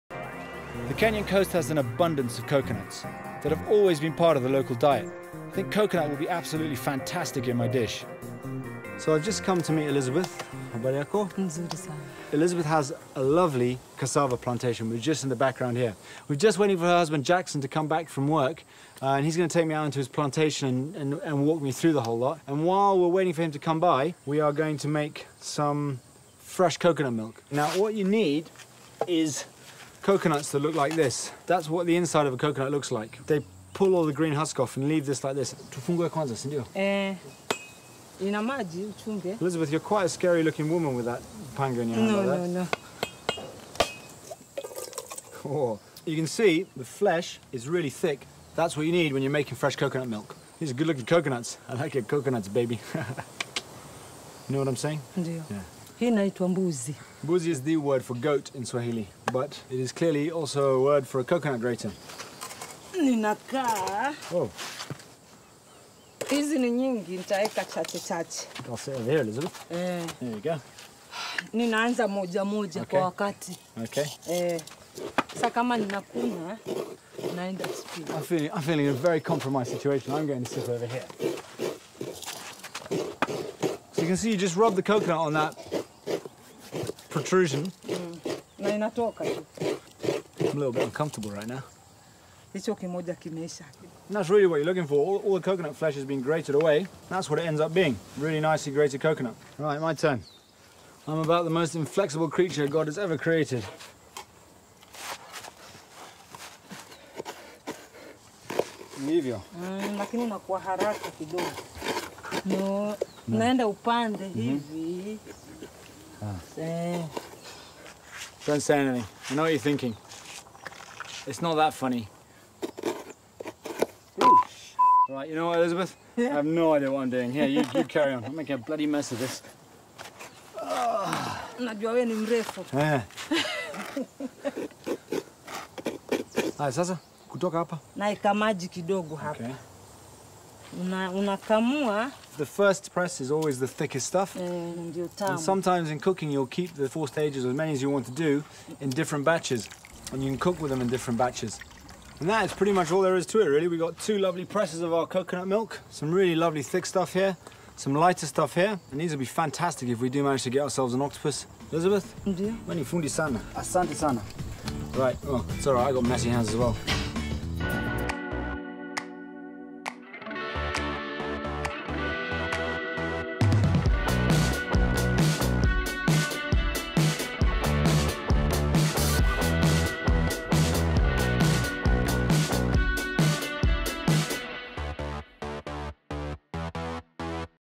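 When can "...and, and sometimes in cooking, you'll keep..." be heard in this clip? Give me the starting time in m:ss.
2:24.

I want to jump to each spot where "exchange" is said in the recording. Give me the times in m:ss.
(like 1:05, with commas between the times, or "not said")
not said.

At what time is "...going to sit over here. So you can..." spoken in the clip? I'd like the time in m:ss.
1:20.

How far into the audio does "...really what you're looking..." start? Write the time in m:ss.
1:34.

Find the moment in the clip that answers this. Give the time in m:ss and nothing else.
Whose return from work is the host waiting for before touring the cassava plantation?
0:17.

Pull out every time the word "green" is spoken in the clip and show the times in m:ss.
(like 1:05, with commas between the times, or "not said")
0:34.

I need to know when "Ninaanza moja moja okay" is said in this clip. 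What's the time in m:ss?
1:11.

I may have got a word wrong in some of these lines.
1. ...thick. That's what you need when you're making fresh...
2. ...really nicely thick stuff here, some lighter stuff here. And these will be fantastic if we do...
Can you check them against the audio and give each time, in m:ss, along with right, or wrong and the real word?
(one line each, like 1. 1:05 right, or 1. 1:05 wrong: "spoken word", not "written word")
1. 0:47 right
2. 2:36 wrong: "lovely", not "nicely".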